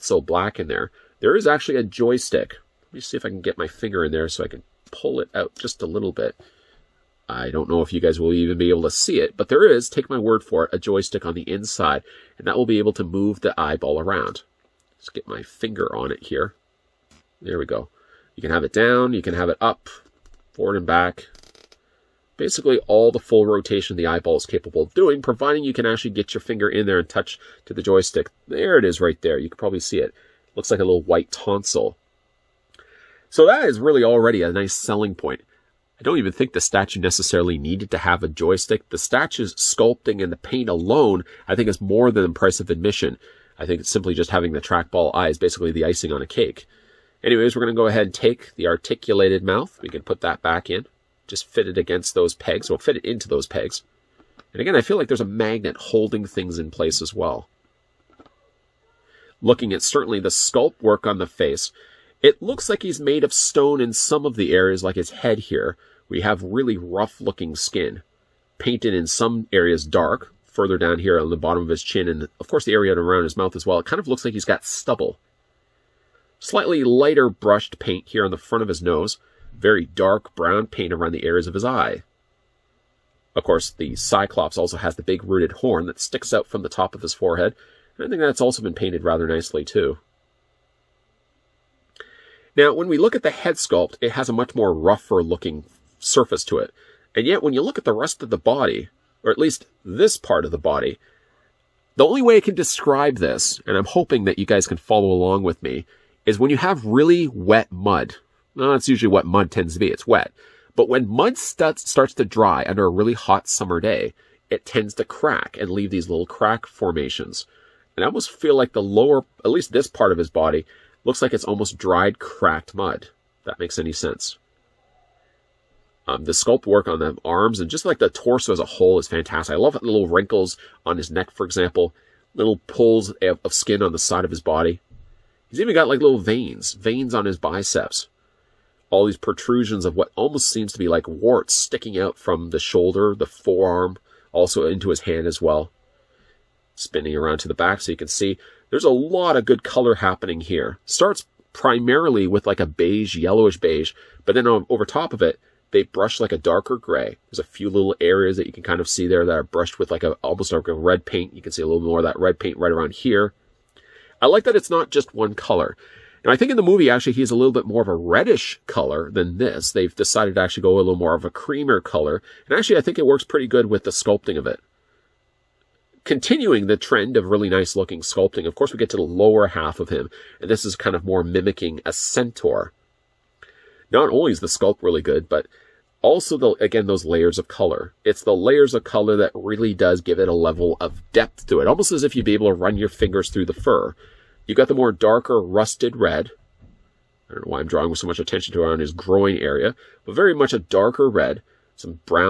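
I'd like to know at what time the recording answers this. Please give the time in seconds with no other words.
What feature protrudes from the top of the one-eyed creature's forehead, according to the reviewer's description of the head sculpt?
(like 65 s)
85 s.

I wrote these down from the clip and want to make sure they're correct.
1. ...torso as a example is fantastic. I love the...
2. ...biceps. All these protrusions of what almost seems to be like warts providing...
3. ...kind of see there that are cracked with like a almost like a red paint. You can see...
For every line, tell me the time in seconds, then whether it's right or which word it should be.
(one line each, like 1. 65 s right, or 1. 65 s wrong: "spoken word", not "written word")
1. 128 s wrong: "whole", not "example"
2. 137 s wrong: "sticking", not "providing"
3. 158 s wrong: "brushed", not "cracked".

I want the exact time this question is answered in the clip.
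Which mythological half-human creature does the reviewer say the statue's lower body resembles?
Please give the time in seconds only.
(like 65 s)
181 s.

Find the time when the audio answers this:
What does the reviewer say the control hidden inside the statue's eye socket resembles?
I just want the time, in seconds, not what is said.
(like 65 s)
30 s.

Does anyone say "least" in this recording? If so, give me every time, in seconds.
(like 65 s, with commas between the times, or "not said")
99 s, 119 s.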